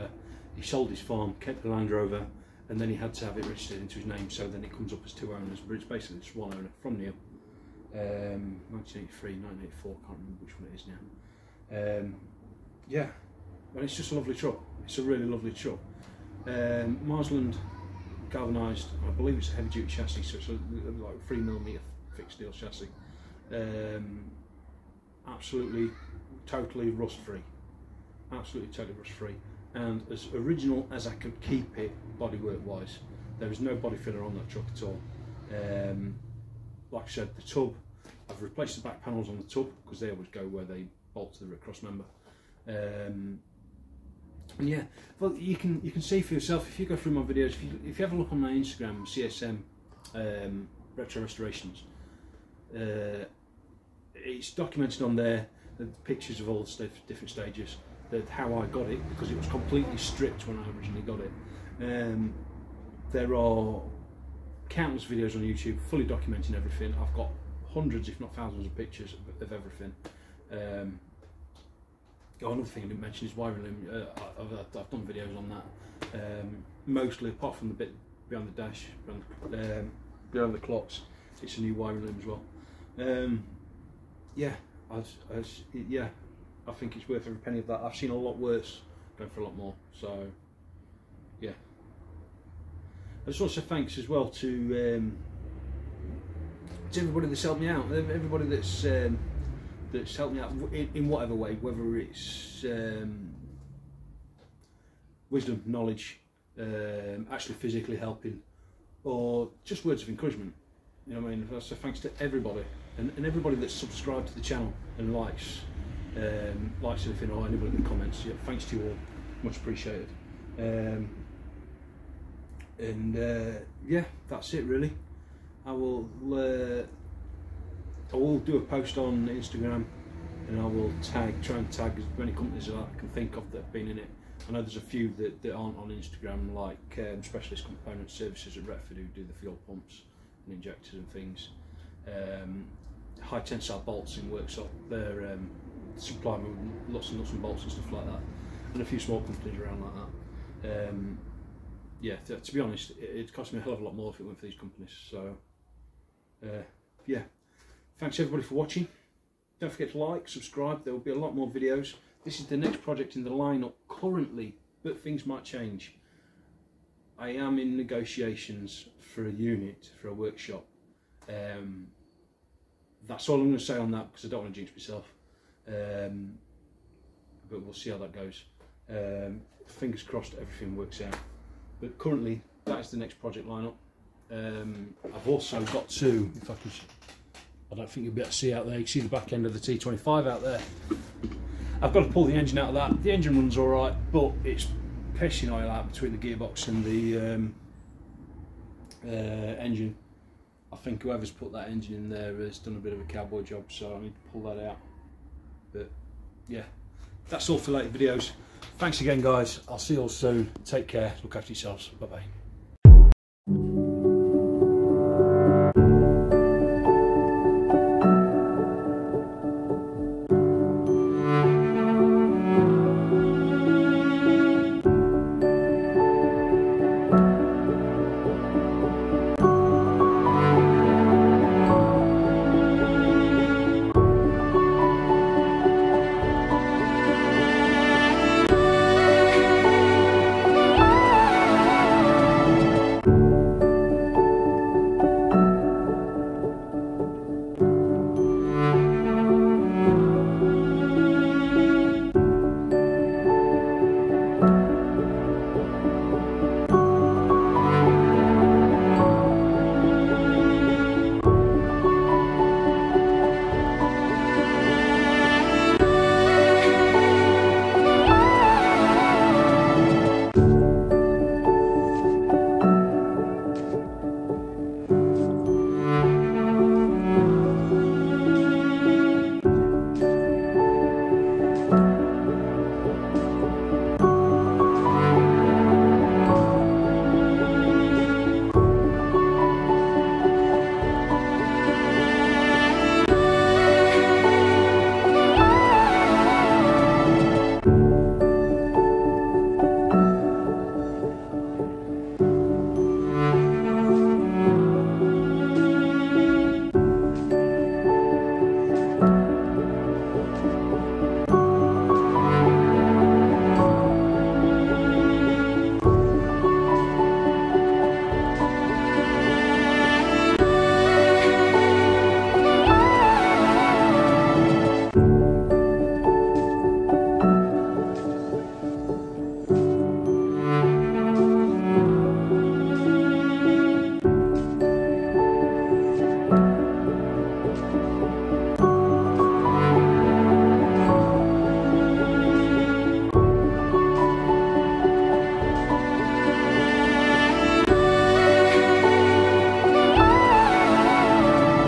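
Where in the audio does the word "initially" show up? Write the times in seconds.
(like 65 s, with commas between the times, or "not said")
not said.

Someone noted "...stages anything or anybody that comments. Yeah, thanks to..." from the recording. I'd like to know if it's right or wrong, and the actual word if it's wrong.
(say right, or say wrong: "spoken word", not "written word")
wrong: "likes", not "stages".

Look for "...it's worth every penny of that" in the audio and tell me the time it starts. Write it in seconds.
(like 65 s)
86 s.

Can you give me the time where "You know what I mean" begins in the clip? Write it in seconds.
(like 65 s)
111 s.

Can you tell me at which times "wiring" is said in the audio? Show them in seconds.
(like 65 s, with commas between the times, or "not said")
73 s, 81 s.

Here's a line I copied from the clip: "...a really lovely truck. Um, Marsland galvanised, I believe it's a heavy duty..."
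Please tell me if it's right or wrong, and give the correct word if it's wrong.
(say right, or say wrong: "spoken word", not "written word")
right.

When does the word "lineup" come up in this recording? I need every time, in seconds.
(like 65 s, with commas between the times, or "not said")
163 s, 183 s.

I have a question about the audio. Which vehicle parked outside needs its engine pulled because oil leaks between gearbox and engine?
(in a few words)
T25.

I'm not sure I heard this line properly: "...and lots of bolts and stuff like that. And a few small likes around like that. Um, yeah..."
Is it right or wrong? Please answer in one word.
wrong.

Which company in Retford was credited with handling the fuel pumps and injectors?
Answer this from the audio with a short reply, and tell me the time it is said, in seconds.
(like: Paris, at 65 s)
Specialist Component Services, at 137 s.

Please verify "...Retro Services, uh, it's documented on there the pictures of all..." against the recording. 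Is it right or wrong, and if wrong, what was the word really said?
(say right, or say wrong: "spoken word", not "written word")
wrong: "Restorations", not "Services".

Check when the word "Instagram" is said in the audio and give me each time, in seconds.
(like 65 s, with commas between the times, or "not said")
48 s, 129 s, 135 s.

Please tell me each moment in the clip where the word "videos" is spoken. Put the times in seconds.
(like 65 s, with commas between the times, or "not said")
47 s, 65 s, 75 s, 161 s, 207 s.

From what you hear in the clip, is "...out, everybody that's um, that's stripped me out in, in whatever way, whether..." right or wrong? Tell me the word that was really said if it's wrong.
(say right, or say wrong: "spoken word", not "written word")
wrong: "helped", not "stripped".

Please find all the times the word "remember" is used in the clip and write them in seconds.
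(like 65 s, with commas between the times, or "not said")
10 s.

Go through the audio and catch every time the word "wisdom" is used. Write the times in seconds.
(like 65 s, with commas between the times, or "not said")
105 s.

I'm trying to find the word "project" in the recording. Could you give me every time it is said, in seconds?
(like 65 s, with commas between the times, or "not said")
162 s, 183 s.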